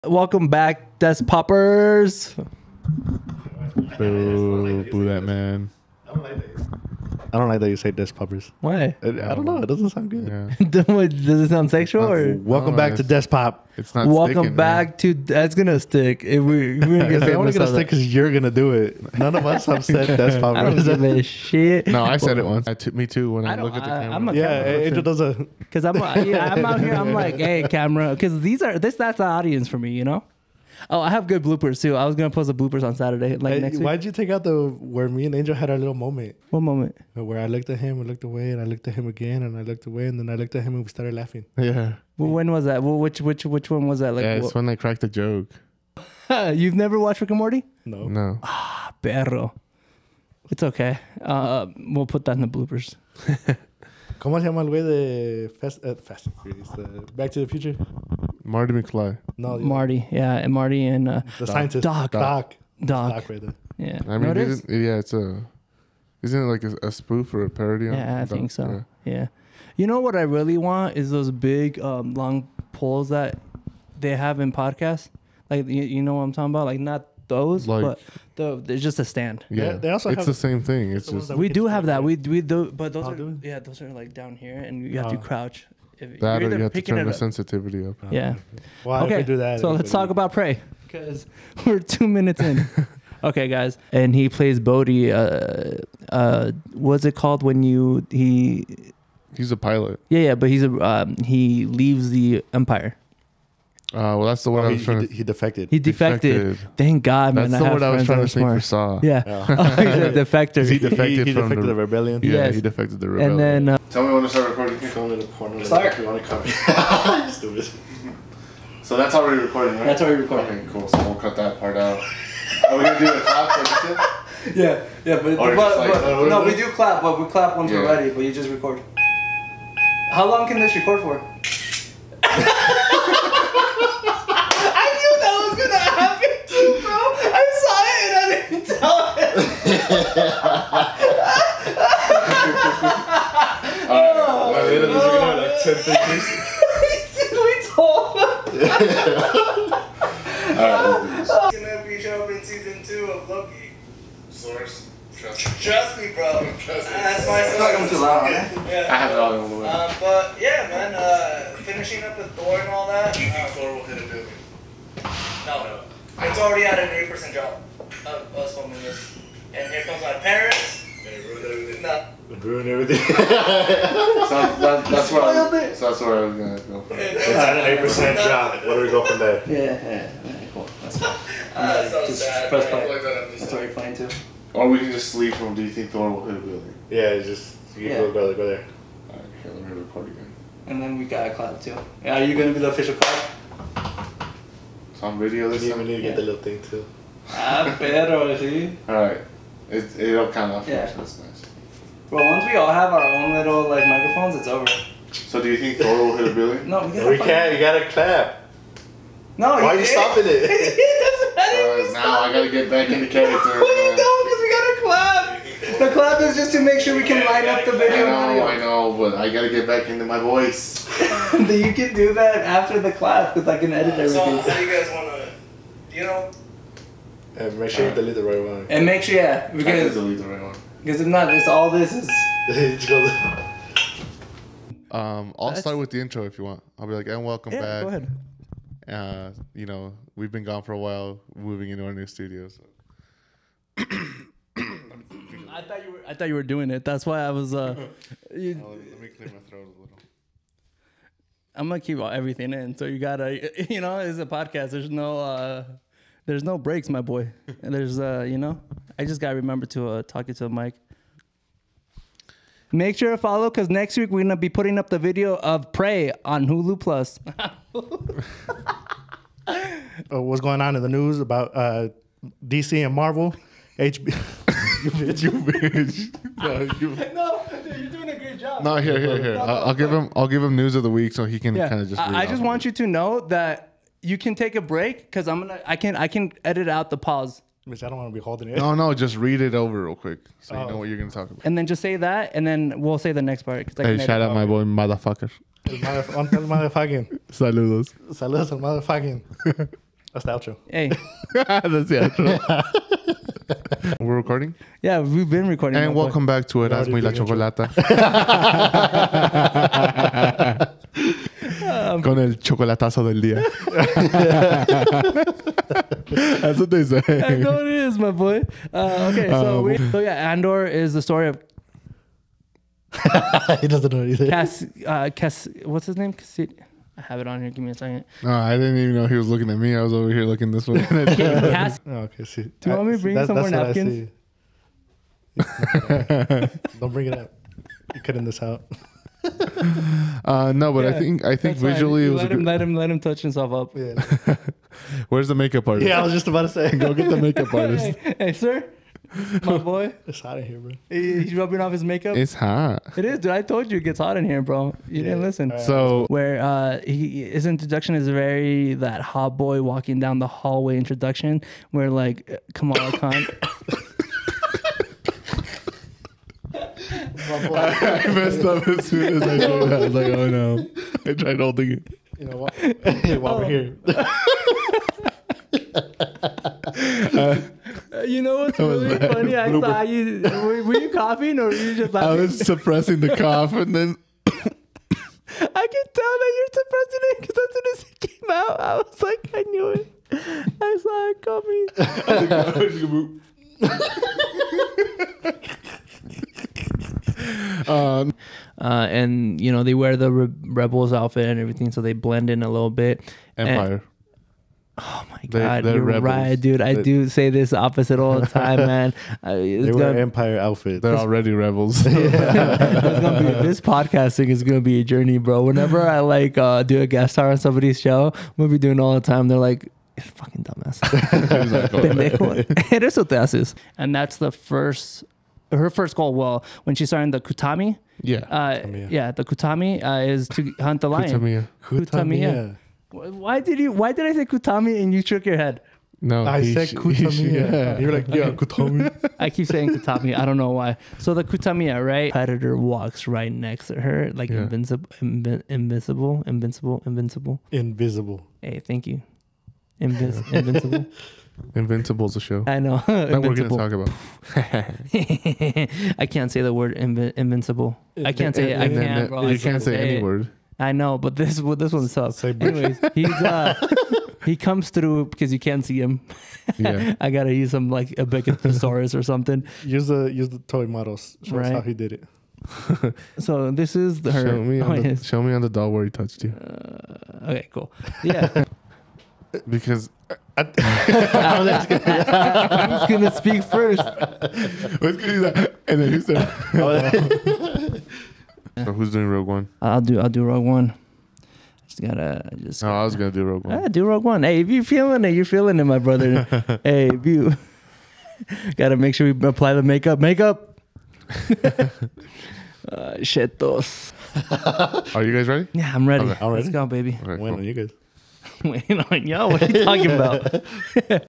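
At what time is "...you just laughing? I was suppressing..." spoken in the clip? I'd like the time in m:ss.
6:21.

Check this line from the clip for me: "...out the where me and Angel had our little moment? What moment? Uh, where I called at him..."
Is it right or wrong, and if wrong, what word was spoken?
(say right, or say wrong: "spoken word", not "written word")
wrong: "looked", not "called".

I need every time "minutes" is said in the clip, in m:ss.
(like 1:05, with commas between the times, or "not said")
1:32.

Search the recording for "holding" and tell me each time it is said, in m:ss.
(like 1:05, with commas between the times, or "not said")
4:48, 6:11.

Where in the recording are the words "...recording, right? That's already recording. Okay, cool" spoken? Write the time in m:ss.
1:59.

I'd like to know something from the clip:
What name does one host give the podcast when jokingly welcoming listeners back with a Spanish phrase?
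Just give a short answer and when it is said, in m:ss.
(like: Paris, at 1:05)
It As Muy La Chocolata, at 5:06.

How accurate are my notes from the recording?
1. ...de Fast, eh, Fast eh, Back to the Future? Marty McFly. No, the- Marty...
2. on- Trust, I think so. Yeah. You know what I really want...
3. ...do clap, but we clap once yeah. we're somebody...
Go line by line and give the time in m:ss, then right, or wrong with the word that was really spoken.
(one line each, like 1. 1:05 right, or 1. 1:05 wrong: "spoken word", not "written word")
1. 0:54 right
2. 1:07 wrong: "Yeah", not "Trust"
3. 2:06 wrong: "ready", not "somebody".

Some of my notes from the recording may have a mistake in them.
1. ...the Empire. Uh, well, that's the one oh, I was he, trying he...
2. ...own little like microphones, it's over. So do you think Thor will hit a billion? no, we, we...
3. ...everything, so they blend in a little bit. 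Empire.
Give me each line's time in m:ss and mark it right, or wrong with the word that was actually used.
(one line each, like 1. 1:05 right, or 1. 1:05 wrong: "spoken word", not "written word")
1. 1:42 right
2. 3:23 right
3. 6:41 right.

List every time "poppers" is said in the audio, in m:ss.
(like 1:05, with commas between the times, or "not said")
0:01, 0:08, 0:20.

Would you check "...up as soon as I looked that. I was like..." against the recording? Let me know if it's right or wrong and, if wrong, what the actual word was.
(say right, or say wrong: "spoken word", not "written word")
wrong: "showed", not "looked".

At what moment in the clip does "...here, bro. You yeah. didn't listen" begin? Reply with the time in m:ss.
5:54.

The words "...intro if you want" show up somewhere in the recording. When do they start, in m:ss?
3:56.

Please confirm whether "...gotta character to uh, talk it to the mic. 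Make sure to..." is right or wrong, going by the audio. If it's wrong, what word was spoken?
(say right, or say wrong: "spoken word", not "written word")
wrong: "remember", not "character".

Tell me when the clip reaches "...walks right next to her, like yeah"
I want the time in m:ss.
7:22.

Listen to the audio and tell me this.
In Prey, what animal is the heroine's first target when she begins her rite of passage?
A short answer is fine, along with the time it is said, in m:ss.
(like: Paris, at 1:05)
lion, at 7:10.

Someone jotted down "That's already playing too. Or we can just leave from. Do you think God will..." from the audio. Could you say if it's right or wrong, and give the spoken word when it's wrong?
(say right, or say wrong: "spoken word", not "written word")
wrong: "Thor", not "God".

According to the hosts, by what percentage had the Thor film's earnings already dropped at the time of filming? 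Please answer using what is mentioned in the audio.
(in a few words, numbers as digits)
8%.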